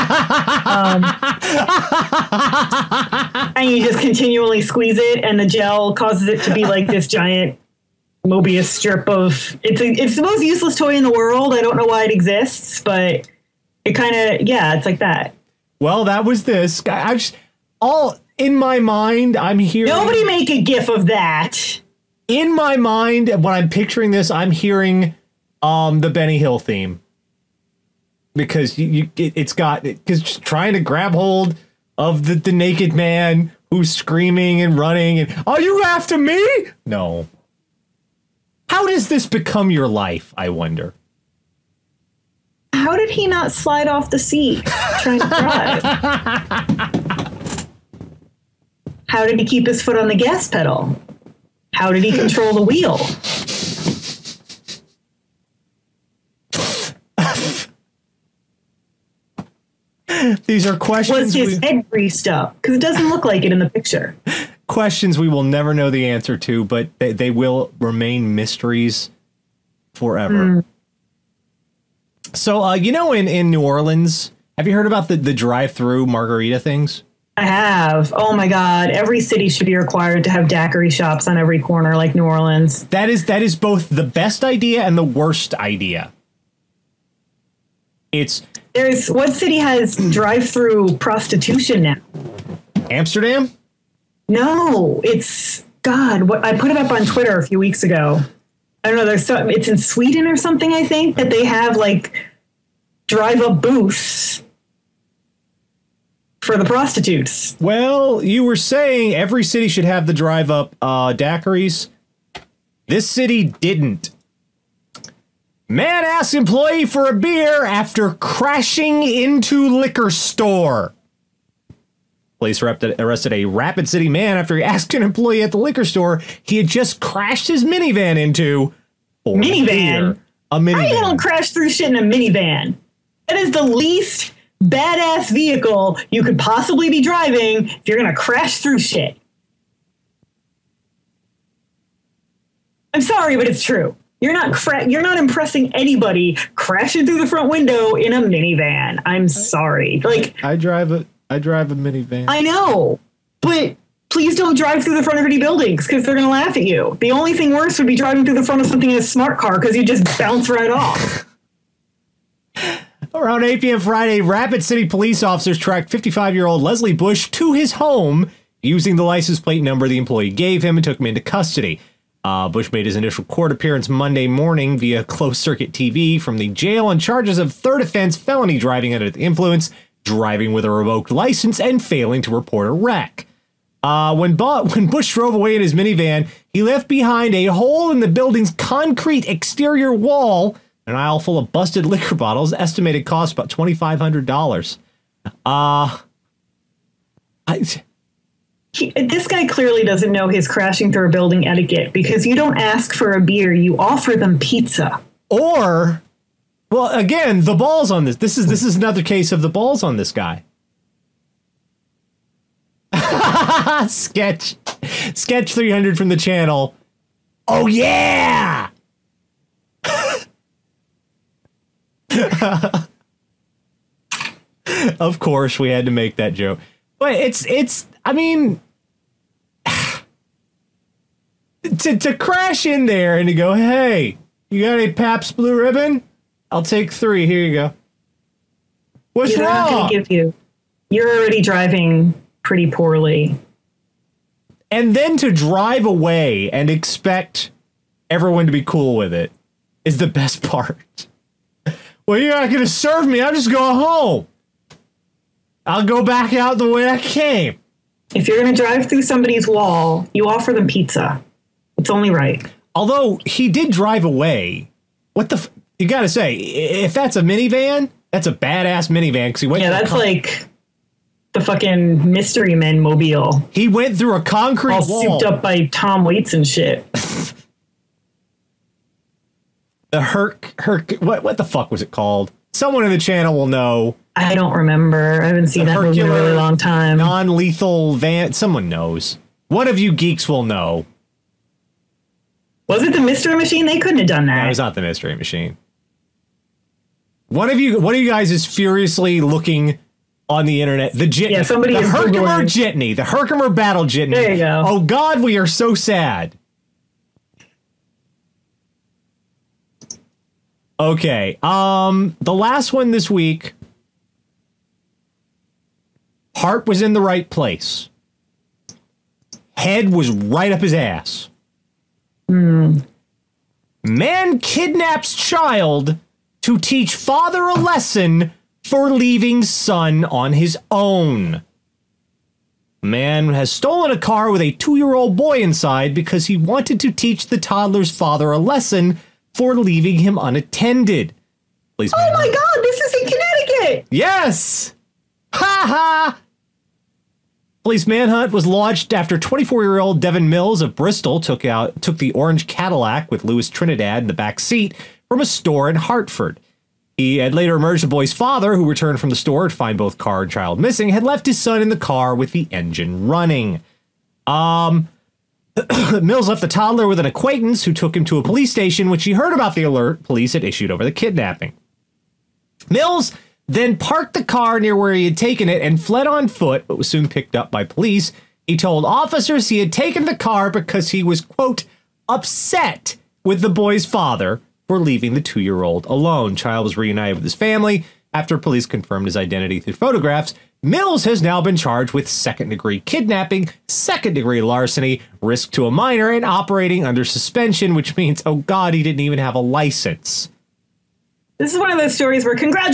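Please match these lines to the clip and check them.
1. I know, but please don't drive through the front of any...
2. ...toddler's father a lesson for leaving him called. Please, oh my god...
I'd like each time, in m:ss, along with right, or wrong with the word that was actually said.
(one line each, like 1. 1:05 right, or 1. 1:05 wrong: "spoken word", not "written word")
1. 2:32 right
2. 5:37 wrong: "unattended", not "called".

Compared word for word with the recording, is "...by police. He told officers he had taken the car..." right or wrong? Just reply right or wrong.
right.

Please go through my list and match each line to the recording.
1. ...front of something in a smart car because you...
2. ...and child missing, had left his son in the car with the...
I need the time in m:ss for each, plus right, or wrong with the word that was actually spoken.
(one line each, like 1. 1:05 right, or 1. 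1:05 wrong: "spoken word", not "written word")
1. 2:38 right
2. 6:00 right.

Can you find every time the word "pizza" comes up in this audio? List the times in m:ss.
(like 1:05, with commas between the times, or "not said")
3:24, 4:20.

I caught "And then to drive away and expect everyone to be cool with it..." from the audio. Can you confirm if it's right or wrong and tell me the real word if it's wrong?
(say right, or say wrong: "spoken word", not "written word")
right.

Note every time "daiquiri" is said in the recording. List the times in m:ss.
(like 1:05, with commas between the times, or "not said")
1:20, 1:51.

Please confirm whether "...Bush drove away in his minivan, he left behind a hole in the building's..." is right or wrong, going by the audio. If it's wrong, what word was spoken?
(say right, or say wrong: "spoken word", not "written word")
right.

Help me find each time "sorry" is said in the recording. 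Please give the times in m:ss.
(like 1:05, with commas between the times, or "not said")
2:23, 2:29.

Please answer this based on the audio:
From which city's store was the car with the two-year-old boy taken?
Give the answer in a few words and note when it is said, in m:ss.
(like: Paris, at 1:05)
Hartford, at 5:55.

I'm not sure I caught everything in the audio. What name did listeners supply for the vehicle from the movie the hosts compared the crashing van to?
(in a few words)
Herkimer battle jitney.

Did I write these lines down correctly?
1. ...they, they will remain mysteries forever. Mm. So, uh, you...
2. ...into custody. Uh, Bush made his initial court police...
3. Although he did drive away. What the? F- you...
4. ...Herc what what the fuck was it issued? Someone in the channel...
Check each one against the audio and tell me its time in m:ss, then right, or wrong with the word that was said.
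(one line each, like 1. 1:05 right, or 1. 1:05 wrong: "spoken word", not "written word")
1. 1:06 right
2. 2:51 wrong: "appearance", not "police"
3. 4:22 right
4. 4:40 wrong: "called", not "issued".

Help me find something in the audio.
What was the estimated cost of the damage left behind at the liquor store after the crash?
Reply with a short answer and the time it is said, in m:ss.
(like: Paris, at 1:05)
$2,500, at 3:13.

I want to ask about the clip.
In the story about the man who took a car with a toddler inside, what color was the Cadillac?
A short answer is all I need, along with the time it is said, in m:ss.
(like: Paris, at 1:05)
Orange, at 5:52.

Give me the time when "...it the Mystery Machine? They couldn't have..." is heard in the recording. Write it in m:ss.
4:52.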